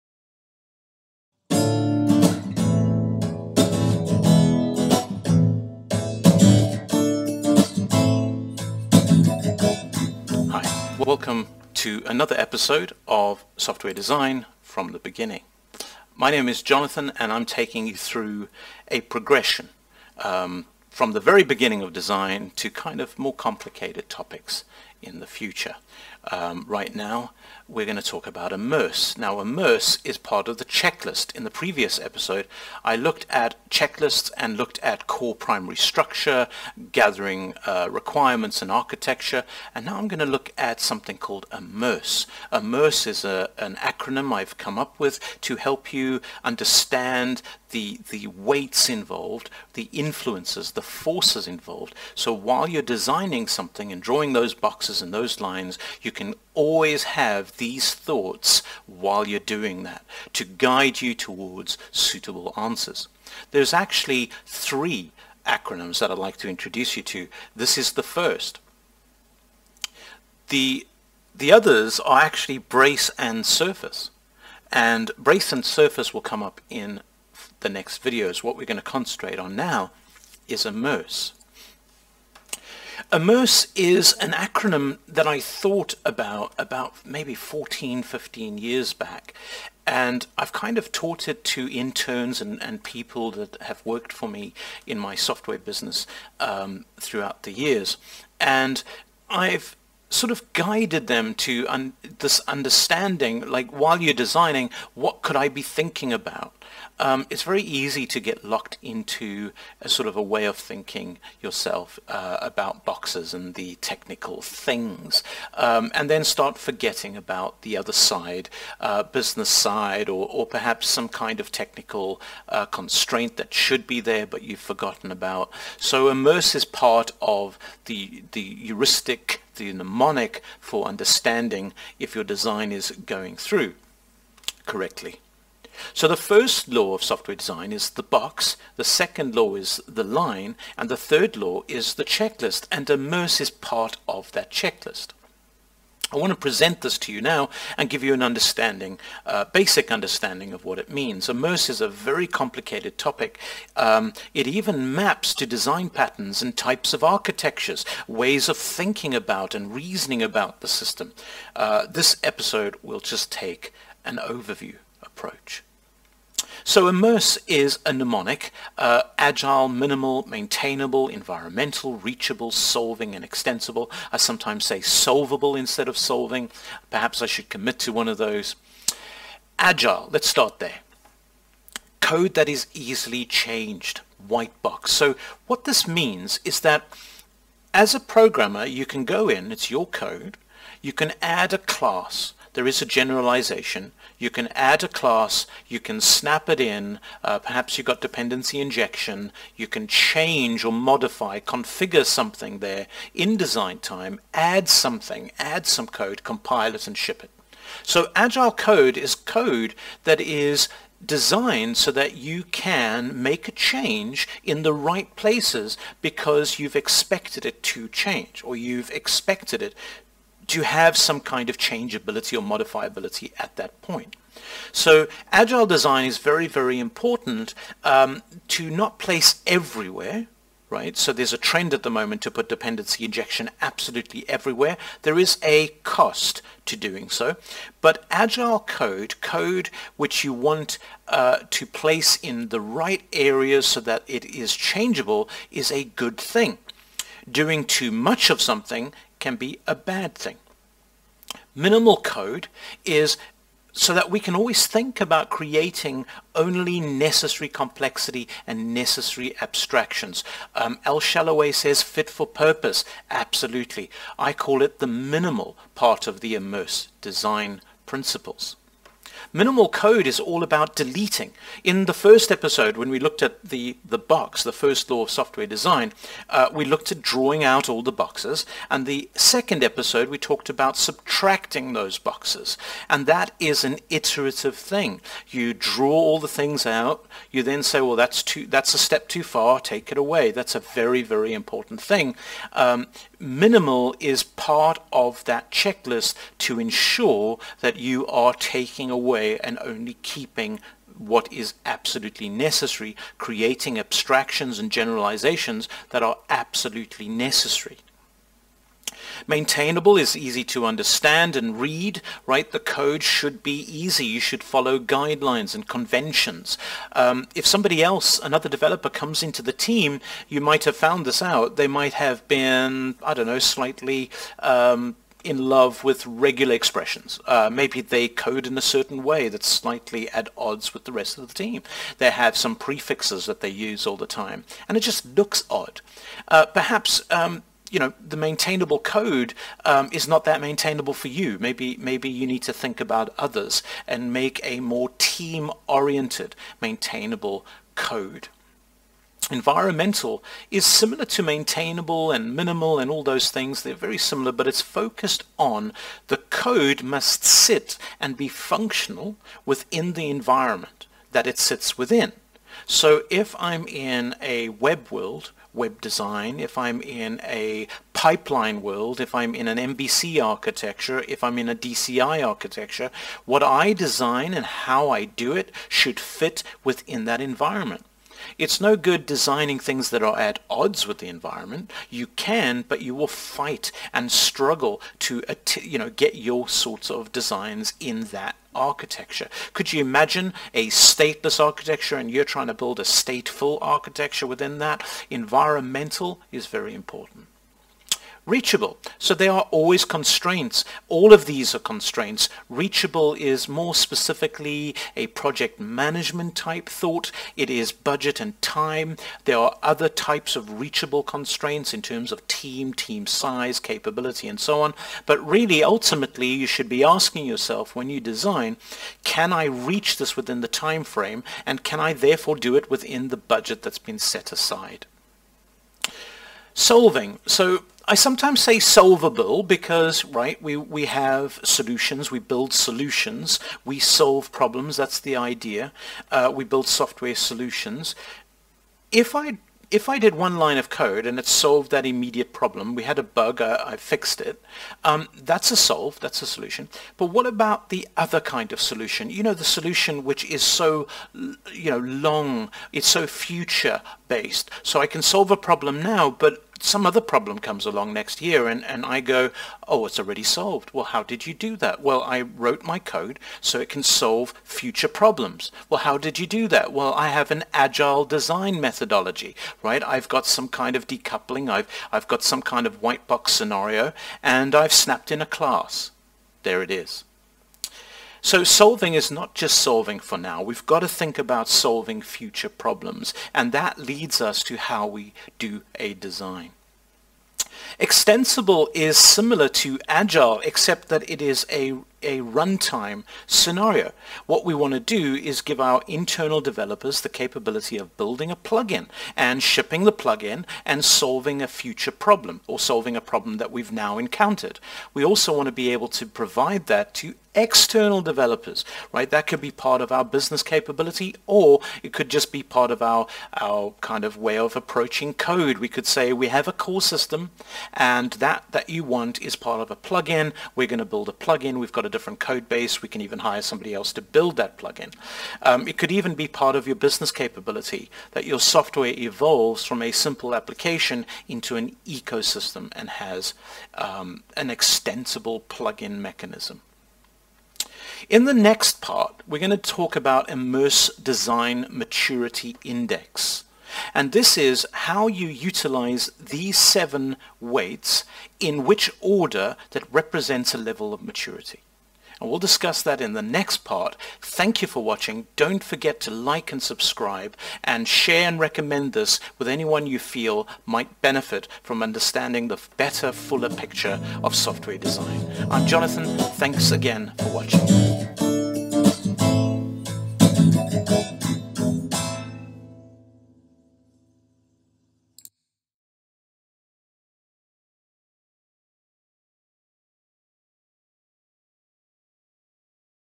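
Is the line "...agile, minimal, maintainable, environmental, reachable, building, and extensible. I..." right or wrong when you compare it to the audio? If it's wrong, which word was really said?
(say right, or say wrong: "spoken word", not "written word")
wrong: "solving", not "building".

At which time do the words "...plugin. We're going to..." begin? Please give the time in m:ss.
8:39.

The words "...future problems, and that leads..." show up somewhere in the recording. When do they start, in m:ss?
8:02.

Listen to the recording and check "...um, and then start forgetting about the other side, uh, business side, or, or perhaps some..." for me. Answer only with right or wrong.
right.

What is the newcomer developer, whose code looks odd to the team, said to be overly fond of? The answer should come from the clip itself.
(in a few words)
regular expressions.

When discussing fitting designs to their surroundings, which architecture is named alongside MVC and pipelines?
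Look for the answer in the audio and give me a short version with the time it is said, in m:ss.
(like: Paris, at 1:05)
DCI, at 6:11.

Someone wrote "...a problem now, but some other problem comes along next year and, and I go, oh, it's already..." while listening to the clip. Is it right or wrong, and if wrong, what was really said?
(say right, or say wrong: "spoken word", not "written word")
right.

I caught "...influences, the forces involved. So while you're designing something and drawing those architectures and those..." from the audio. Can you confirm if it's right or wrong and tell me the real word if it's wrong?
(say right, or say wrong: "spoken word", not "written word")
wrong: "boxes", not "architectures".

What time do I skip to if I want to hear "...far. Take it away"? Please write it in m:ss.
4:49.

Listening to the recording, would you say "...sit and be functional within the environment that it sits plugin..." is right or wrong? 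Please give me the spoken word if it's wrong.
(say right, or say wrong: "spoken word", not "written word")
wrong: "within", not "plugin".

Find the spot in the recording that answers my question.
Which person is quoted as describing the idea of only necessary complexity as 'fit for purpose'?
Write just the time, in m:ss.
4:20.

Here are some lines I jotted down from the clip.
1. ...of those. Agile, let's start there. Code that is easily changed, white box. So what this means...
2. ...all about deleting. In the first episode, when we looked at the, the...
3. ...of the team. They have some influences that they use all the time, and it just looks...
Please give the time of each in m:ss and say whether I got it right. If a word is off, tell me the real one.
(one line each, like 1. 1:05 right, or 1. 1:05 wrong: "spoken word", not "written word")
1. 2:58 right
2. 4:30 right
3. 5:31 wrong: "prefixes", not "influences".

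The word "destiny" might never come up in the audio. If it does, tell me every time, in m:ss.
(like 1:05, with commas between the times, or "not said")
not said.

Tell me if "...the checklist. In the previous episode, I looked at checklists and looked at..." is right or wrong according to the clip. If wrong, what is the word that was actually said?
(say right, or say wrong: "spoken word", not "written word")
right.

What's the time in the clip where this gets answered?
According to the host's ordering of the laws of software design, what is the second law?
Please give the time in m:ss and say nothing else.
2:19.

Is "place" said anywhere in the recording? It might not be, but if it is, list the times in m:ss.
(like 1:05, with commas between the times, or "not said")
3:35, 3:48, 4:01.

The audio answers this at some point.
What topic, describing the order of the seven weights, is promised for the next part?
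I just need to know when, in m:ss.
9:00.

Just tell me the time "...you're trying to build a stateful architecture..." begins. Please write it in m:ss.
6:32.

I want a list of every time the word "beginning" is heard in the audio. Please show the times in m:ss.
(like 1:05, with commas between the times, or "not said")
0:14, 0:21.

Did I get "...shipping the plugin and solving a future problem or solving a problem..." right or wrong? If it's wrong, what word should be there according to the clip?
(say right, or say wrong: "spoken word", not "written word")
right.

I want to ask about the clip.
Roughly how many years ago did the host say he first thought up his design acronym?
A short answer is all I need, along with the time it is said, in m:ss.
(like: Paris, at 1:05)
14, 15 years, at 1:27.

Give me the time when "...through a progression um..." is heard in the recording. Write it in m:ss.
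0:17.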